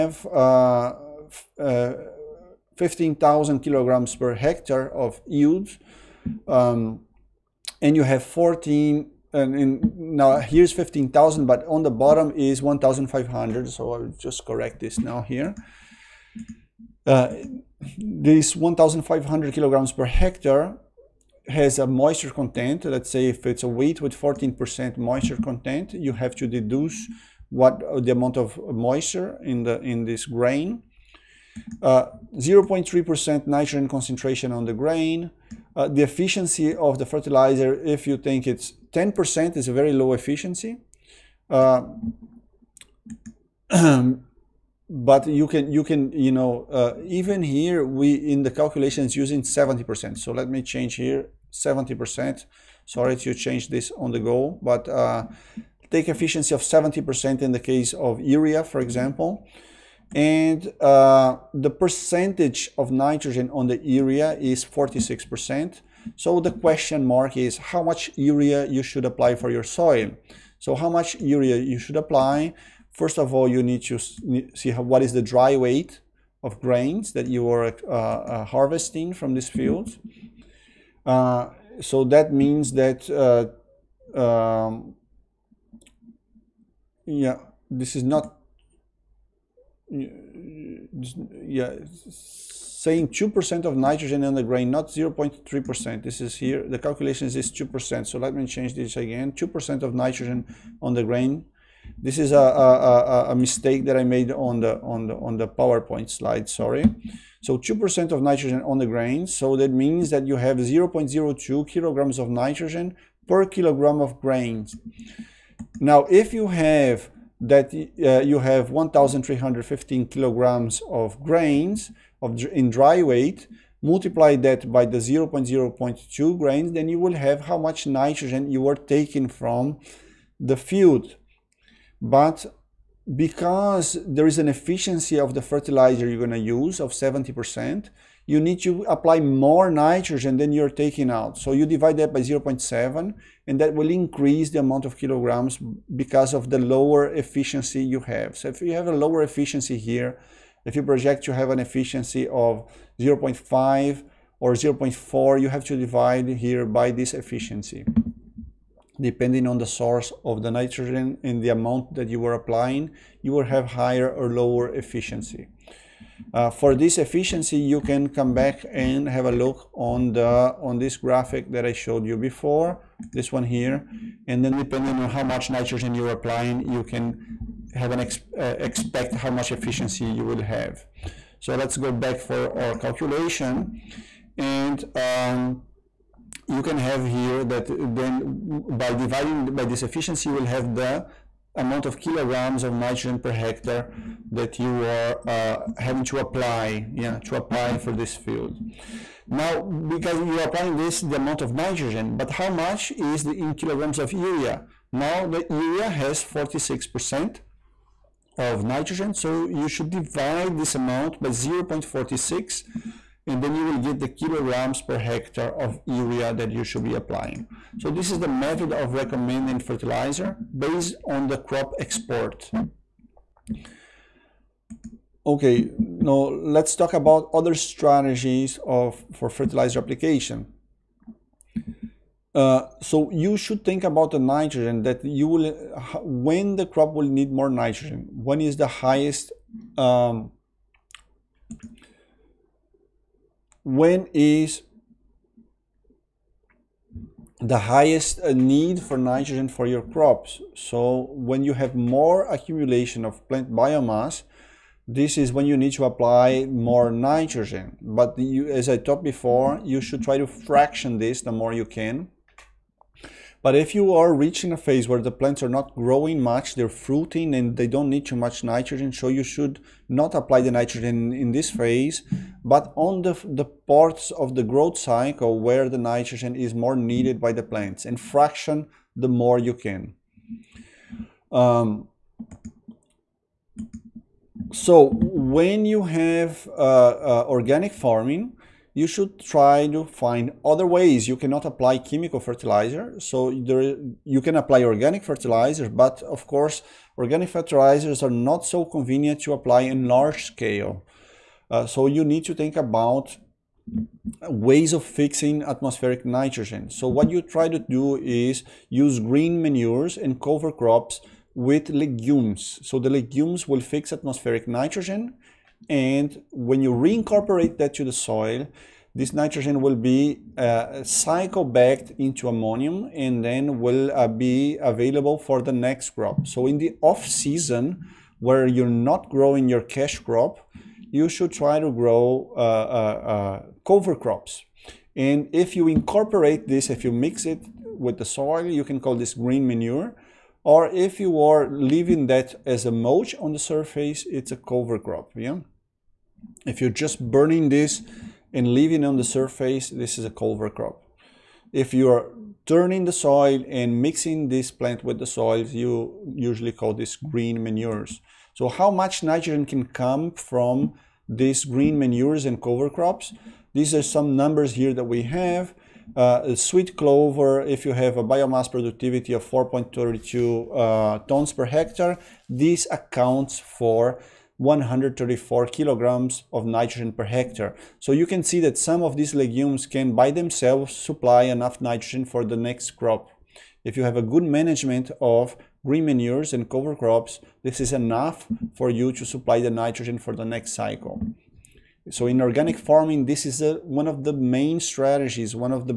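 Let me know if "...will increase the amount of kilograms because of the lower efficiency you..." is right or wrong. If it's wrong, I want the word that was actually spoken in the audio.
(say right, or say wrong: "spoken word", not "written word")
right.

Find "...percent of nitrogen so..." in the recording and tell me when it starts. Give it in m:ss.
3:26.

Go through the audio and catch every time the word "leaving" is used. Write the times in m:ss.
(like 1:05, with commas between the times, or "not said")
5:41, 5:48.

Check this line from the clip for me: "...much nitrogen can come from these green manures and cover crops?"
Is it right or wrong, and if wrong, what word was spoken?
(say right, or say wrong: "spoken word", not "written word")
right.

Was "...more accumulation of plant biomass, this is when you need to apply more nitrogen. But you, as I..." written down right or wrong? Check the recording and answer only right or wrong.
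right.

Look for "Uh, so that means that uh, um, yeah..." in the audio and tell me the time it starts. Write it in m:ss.
1:21.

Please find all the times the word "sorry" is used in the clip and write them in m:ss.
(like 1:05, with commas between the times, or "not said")
0:52, 1:46.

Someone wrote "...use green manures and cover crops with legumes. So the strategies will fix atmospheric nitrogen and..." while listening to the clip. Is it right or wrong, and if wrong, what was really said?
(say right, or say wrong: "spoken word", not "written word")
wrong: "legumes", not "strategies".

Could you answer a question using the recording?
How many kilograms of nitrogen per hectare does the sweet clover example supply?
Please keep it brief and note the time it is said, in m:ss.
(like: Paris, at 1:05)
134 kilograms, at 6:14.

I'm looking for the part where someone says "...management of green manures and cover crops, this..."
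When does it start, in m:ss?
6:24.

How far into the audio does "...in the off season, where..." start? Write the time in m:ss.
5:26.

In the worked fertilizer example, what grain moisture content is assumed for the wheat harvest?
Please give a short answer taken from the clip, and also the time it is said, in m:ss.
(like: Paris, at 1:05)
14%, at 0:24.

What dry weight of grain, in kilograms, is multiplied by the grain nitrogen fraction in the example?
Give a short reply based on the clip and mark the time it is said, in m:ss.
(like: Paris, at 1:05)
1,315 kilograms, at 1:58.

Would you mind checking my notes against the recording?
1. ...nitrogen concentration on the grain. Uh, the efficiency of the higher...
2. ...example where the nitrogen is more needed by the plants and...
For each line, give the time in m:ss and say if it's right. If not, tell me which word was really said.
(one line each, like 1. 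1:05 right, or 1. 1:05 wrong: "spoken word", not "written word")
1. 0:33 wrong: "fertilizer", not "higher"
2. 4:34 wrong: "cycle", not "example".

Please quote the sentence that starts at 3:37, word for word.
So this is the method of recommending fertilizer based on the crop export.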